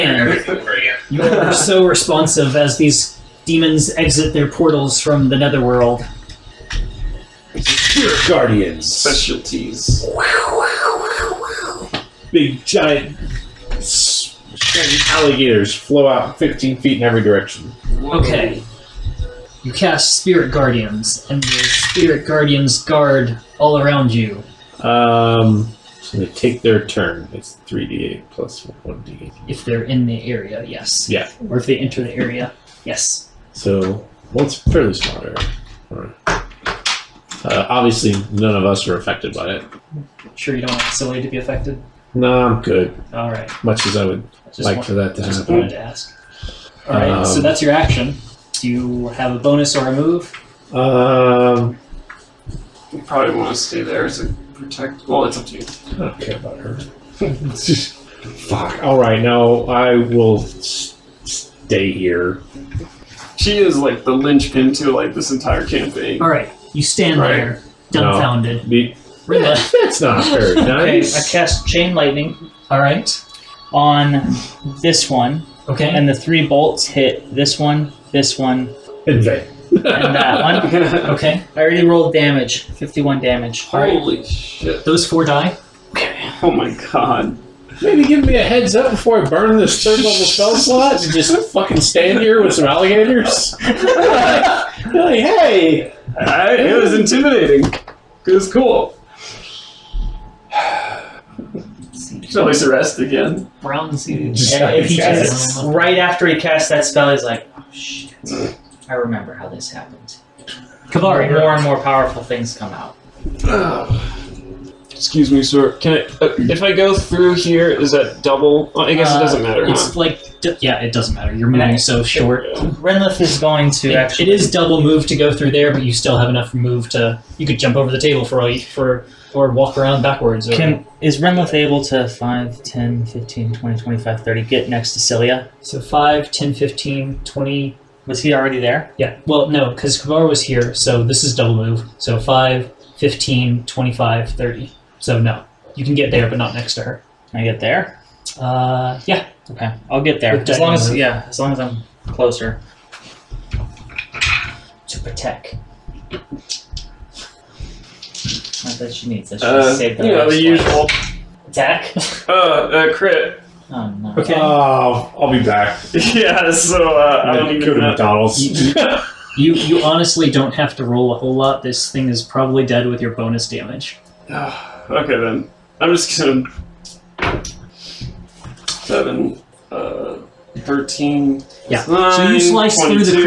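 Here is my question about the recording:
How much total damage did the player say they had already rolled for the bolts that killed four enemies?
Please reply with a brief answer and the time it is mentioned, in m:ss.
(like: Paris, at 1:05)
51, at 1:22.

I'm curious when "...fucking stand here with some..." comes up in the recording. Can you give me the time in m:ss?
1:31.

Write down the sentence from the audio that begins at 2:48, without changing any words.
You, you, you honestly don't have to roll a whole lot.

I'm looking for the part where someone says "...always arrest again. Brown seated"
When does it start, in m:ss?
1:42.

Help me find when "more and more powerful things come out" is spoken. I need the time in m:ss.
1:50.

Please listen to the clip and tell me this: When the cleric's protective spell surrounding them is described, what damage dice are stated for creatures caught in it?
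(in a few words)
3d8 plus 1d8.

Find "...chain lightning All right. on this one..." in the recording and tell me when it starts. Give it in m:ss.
1:11.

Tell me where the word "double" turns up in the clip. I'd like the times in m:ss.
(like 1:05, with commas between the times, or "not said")
1:58, 2:04, 2:21.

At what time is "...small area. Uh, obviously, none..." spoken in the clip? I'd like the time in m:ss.
0:34.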